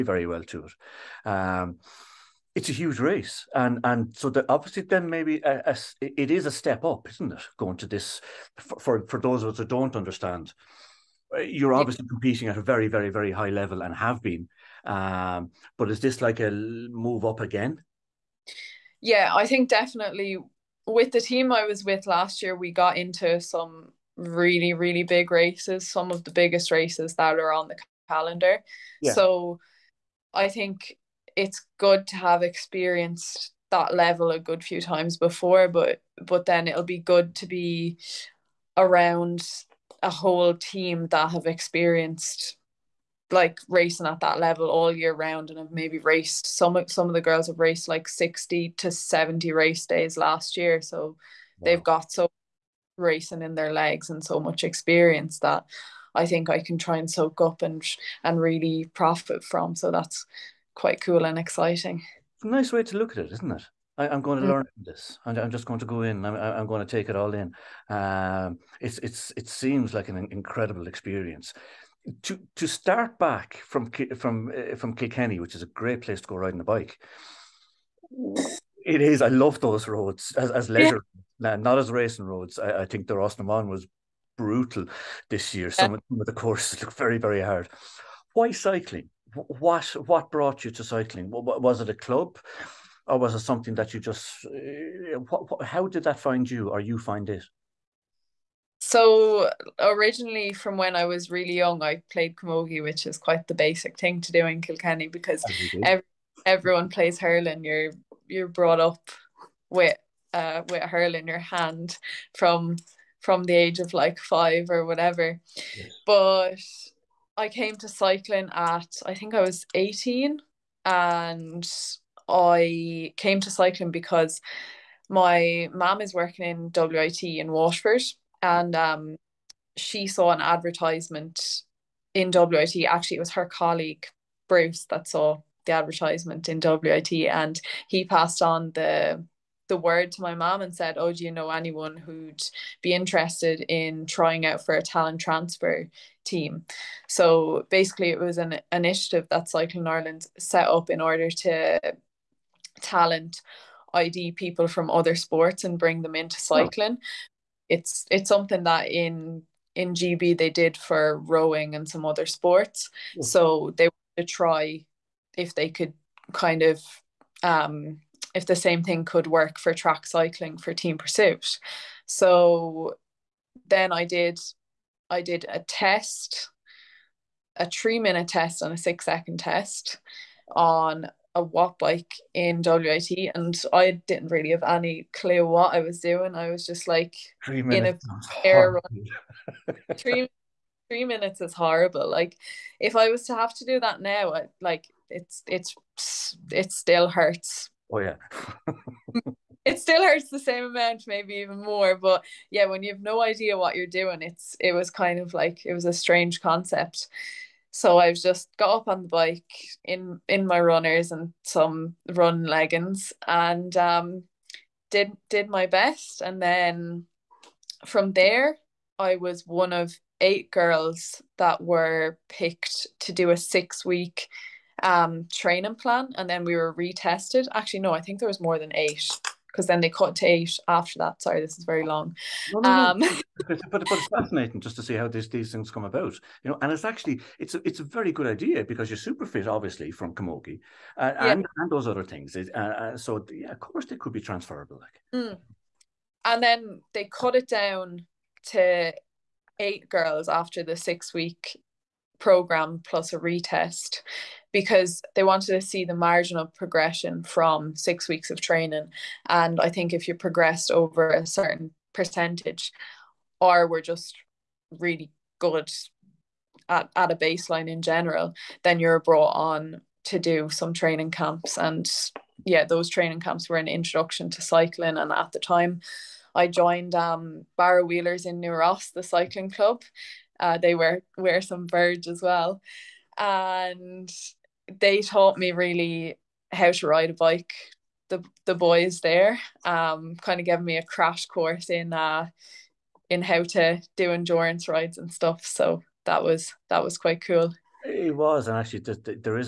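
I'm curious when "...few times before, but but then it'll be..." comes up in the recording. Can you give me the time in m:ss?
0:34.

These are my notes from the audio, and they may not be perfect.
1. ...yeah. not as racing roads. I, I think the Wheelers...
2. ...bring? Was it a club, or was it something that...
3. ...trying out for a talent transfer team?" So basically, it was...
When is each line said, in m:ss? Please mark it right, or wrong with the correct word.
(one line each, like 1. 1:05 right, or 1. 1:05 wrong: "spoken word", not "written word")
1. 1:21 wrong: "Rás", not "Wheelers"
2. 1:30 wrong: "cycling", not "bring"
3. 2:24 right.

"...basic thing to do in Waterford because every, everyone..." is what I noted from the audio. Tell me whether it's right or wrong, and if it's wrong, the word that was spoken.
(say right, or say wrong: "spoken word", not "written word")
wrong: "Kilkenny", not "Waterford".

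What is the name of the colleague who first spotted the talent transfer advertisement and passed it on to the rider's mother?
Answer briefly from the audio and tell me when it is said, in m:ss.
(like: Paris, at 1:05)
Bruce, at 2:14.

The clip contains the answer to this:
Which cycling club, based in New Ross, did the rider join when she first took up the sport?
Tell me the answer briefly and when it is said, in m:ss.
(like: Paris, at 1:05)
Barrow Wheelers, at 4:37.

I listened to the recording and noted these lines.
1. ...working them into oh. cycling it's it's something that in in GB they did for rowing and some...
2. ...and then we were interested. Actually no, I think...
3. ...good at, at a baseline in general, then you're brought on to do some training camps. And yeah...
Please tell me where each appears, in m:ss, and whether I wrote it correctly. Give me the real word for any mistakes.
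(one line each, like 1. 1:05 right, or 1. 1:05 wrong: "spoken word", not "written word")
1. 2:35 wrong: "bring", not "working"
2. 3:46 wrong: "retested", not "interested"
3. 4:25 right.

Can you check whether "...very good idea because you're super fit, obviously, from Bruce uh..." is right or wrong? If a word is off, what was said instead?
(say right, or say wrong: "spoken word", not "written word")
wrong: "Camogie", not "Bruce".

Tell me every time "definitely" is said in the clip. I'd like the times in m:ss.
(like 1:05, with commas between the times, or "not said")
0:19.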